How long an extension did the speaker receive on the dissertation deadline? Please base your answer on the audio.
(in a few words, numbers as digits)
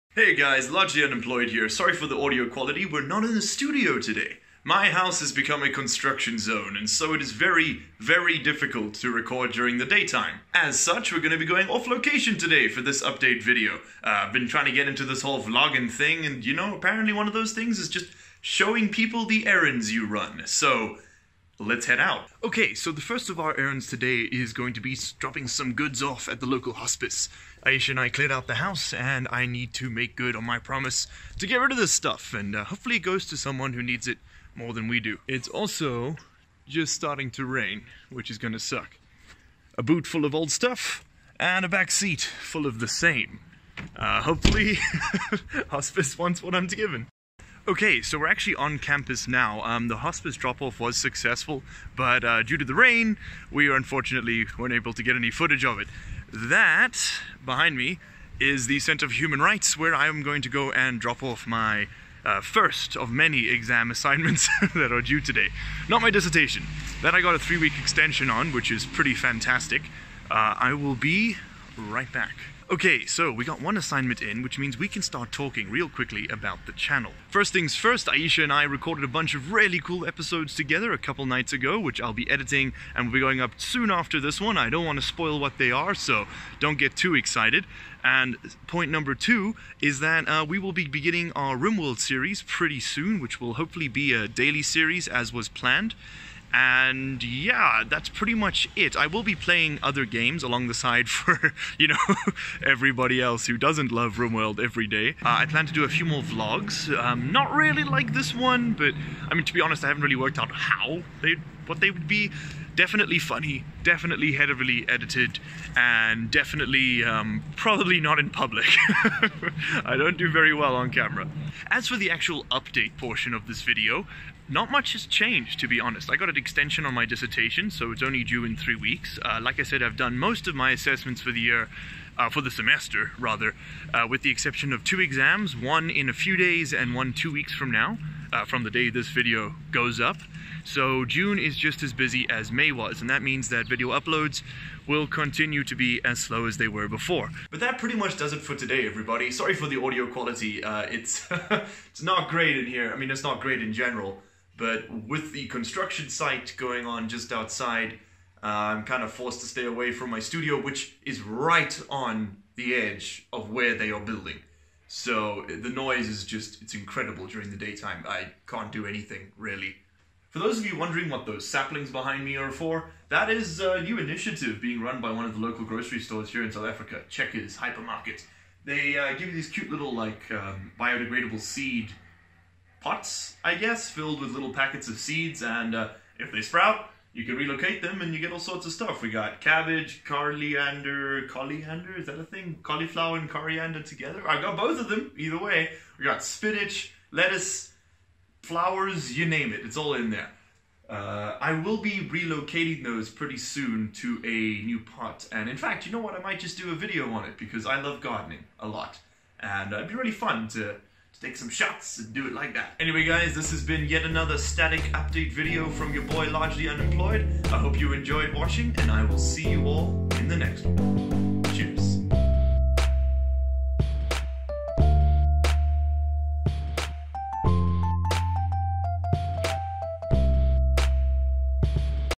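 3 weeks.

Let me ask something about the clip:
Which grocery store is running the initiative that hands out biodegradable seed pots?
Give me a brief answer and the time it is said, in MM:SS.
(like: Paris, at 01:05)
Checkers Hypermarket, at 02:57.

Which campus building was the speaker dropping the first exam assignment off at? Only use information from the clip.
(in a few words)
Center for Human Rights.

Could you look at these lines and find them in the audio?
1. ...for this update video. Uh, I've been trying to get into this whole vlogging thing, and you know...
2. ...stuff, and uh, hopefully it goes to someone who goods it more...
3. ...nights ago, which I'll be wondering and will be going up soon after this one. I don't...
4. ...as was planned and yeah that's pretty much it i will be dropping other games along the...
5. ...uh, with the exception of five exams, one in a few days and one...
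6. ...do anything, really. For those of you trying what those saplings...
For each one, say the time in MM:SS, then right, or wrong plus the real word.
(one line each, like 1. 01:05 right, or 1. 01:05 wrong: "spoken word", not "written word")
1. 00:12 right
2. 00:31 wrong: "needs", not "goods"
3. 01:21 wrong: "editing", not "wondering"
4. 01:35 wrong: "playing", not "dropping"
5. 02:13 wrong: "two", not "five"
6. 02:48 wrong: "wondering", not "trying".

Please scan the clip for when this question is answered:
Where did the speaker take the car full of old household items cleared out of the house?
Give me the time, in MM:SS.
00:26.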